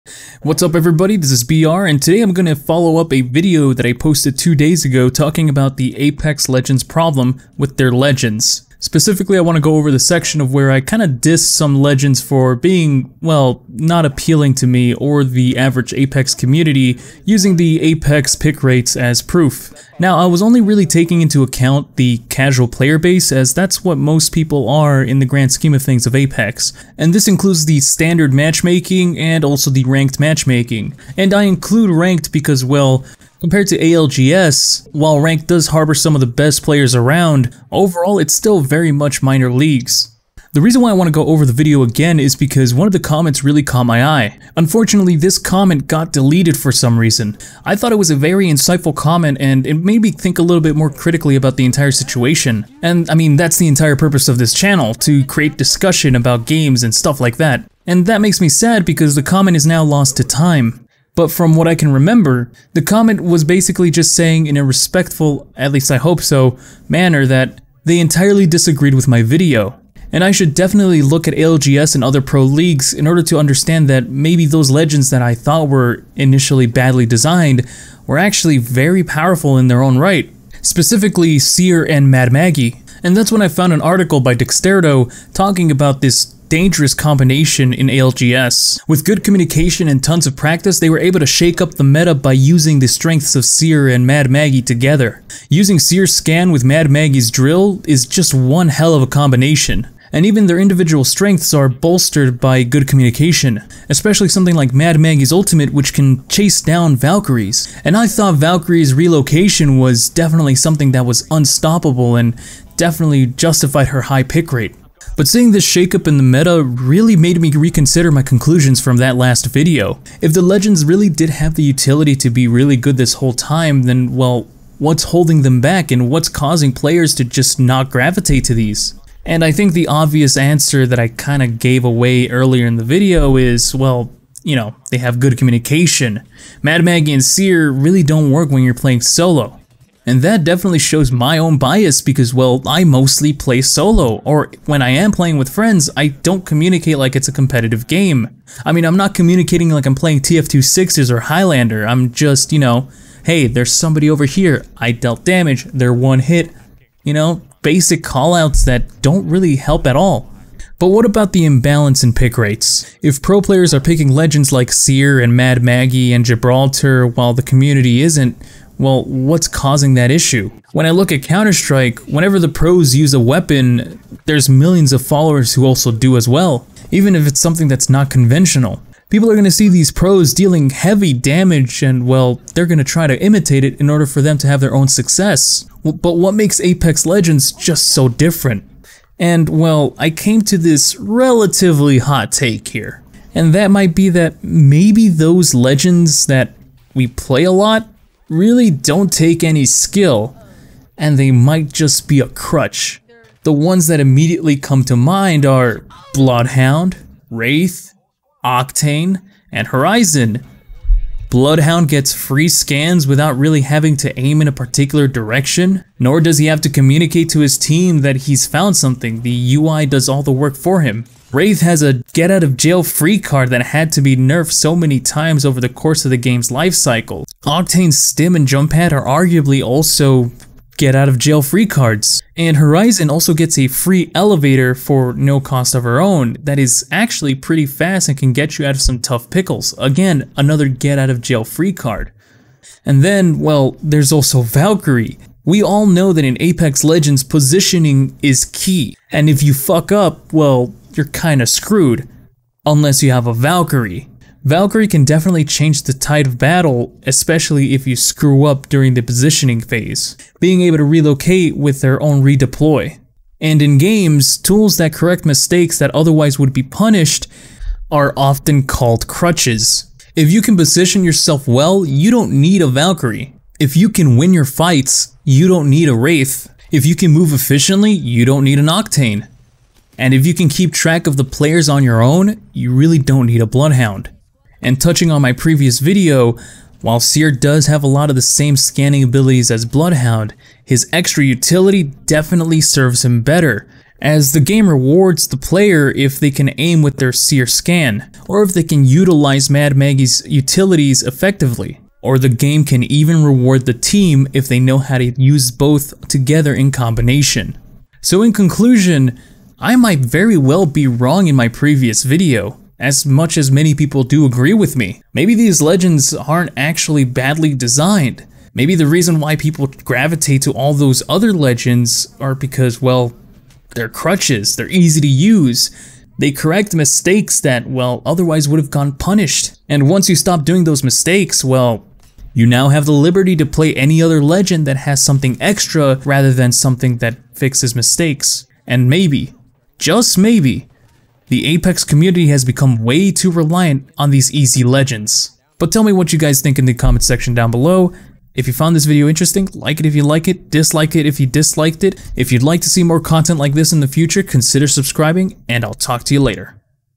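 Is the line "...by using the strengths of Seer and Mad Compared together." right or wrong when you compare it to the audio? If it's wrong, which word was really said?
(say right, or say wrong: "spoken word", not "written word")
wrong: "Maggie", not "Compared".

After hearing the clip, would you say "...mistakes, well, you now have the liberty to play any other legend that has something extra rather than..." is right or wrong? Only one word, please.
right.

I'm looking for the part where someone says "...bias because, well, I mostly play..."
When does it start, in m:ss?
2:21.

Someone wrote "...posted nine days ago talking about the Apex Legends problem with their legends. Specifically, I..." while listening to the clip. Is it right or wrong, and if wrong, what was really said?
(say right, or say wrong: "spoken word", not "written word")
wrong: "two", not "nine".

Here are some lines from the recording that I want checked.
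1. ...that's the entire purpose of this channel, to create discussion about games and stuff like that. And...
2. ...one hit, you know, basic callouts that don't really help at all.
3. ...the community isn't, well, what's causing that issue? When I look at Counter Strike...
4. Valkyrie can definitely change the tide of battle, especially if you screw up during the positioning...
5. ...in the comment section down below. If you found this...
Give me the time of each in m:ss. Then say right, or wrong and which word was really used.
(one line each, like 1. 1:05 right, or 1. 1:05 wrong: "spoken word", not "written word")
1. 0:53 right
2. 2:35 right
3. 2:47 right
4. 4:14 right
5. 5:46 right.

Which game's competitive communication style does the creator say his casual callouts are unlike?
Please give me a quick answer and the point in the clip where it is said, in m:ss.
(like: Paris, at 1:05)
TF2, at 2:30.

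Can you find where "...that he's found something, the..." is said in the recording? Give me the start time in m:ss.
3:37.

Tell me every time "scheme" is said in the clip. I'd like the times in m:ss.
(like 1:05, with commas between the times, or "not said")
0:25.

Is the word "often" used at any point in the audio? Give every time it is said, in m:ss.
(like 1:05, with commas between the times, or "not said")
4:28.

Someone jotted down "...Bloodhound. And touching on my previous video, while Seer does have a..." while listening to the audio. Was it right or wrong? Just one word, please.
right.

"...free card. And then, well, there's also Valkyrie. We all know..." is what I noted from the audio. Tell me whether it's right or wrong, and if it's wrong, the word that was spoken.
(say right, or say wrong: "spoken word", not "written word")
right.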